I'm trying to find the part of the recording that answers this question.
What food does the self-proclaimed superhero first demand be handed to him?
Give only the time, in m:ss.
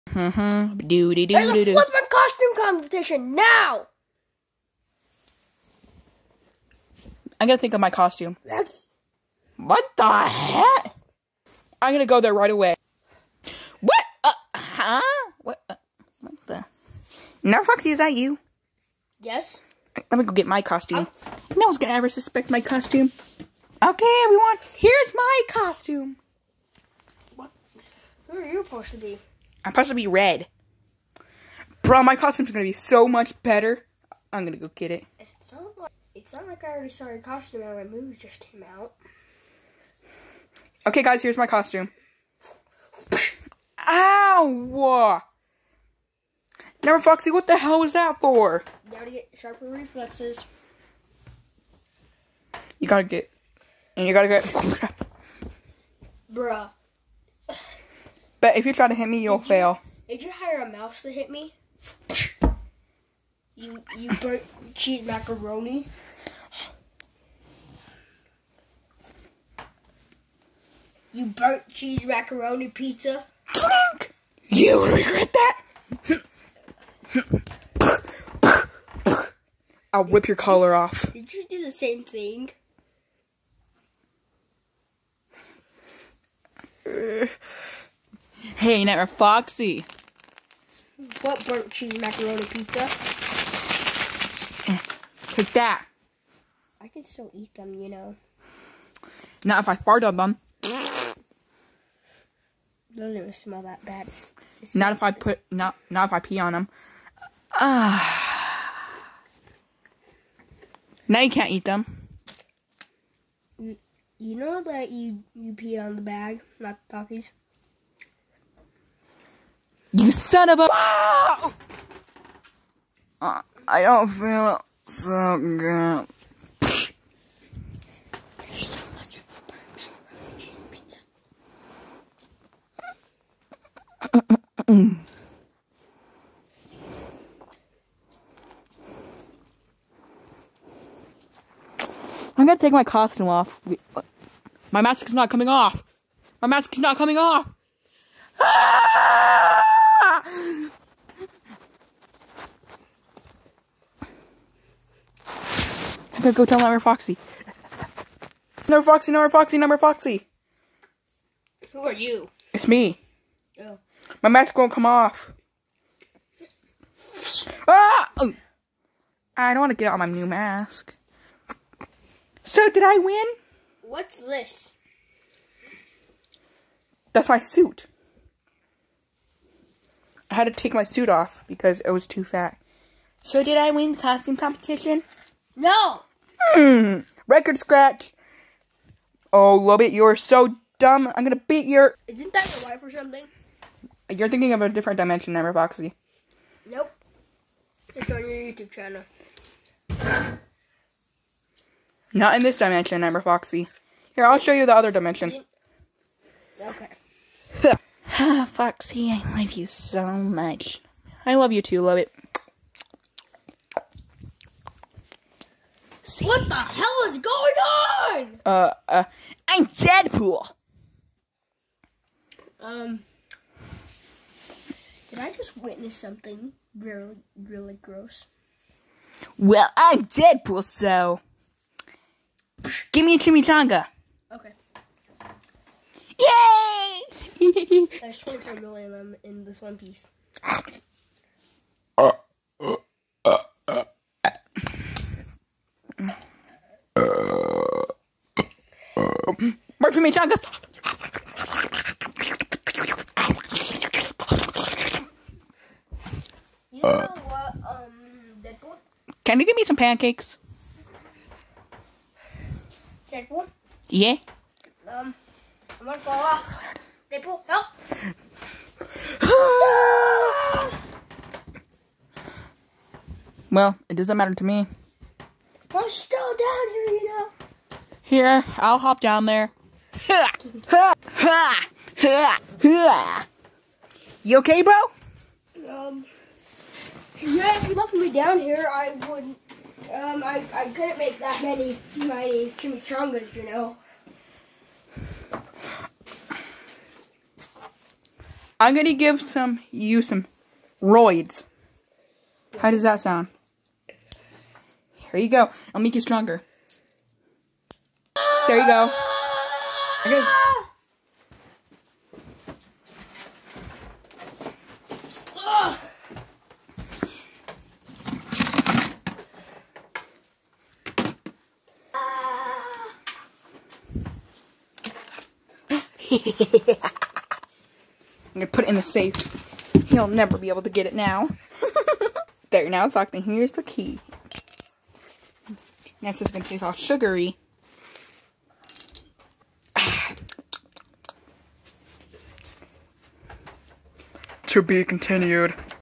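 3:53.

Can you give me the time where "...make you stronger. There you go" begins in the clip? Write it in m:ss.
5:05.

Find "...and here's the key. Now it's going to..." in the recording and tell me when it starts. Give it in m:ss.
5:33.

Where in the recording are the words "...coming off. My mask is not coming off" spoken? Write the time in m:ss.
2:25.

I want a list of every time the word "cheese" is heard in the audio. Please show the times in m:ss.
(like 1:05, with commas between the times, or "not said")
1:04, 1:11, 1:31.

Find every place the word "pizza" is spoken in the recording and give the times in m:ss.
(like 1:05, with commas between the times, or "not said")
1:12, 1:32.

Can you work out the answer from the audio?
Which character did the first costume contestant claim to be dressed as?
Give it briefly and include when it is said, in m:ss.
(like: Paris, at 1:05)
Red, at 0:29.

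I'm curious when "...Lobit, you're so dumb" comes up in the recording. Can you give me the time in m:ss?
3:09.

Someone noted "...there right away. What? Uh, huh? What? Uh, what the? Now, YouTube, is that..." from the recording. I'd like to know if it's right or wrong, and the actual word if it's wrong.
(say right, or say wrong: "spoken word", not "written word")
wrong: "Foxy", not "YouTube".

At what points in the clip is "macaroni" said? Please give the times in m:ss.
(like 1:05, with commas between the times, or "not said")
1:05, 1:12, 1:31.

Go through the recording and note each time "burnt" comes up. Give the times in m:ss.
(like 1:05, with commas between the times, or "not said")
1:04, 1:11, 1:31.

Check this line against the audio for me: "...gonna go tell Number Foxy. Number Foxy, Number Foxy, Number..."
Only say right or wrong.
right.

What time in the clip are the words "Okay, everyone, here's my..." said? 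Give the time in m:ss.
0:23.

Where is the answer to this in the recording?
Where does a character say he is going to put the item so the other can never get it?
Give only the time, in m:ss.
5:28.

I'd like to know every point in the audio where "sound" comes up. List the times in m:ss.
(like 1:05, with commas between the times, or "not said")
5:02.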